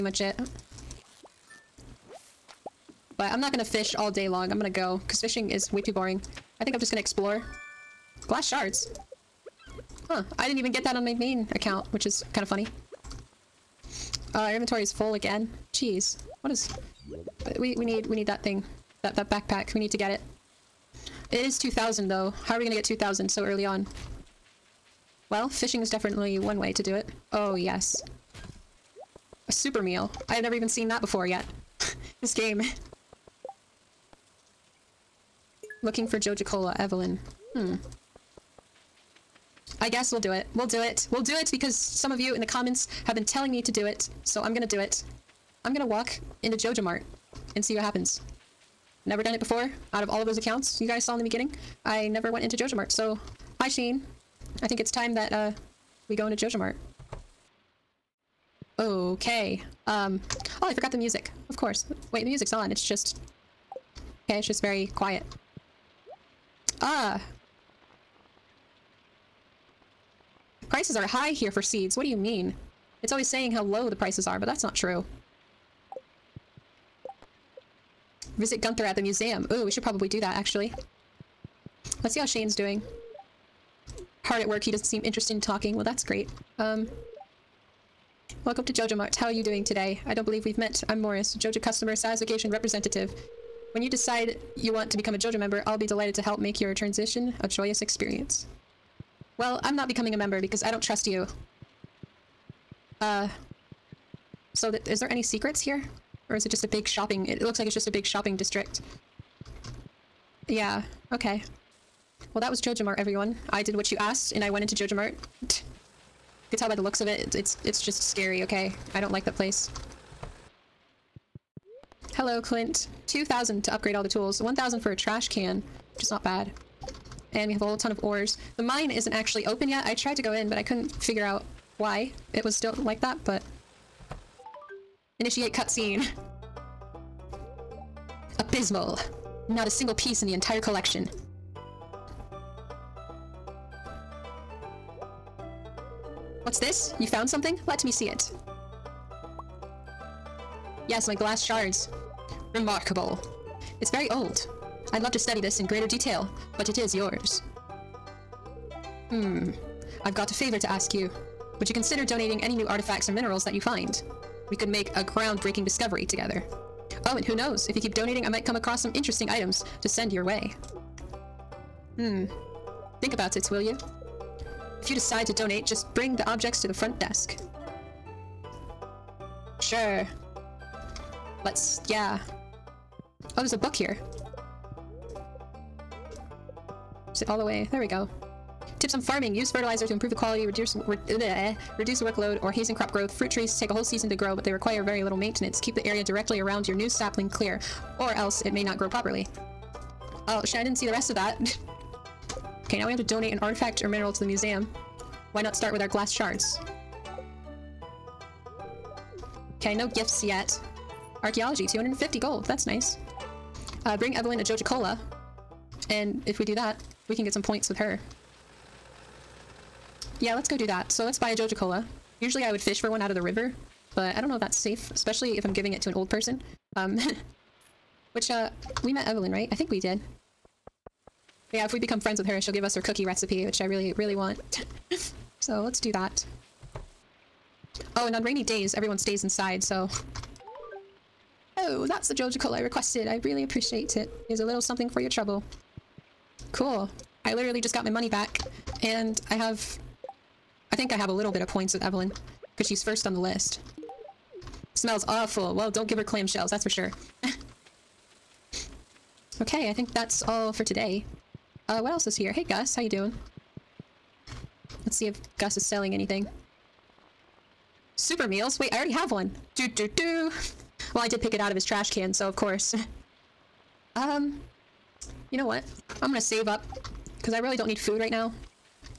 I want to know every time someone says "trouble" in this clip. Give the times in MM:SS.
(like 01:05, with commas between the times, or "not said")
04:05.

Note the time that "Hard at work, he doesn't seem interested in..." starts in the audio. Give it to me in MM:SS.
01:24.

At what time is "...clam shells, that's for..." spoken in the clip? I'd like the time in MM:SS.
04:16.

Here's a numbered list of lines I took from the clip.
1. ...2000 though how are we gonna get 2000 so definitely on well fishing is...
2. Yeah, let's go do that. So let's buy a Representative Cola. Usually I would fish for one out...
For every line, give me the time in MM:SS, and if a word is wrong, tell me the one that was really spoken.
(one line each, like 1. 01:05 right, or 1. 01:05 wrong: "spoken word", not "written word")
1. 00:21 wrong: "early", not "definitely"
2. 03:40 wrong: "Joja", not "Representative".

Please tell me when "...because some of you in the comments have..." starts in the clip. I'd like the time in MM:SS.
00:41.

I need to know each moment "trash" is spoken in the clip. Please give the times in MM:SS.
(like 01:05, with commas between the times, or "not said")
02:04, 04:31.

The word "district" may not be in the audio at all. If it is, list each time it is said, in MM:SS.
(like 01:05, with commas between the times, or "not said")
01:48.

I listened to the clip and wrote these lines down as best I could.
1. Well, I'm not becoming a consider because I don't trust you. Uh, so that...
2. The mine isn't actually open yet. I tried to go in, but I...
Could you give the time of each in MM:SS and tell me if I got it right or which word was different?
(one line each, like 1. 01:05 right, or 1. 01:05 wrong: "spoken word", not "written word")
1. 01:39 wrong: "member", not "consider"
2. 02:08 right.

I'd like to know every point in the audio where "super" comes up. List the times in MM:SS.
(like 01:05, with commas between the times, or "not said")
00:29, 04:27.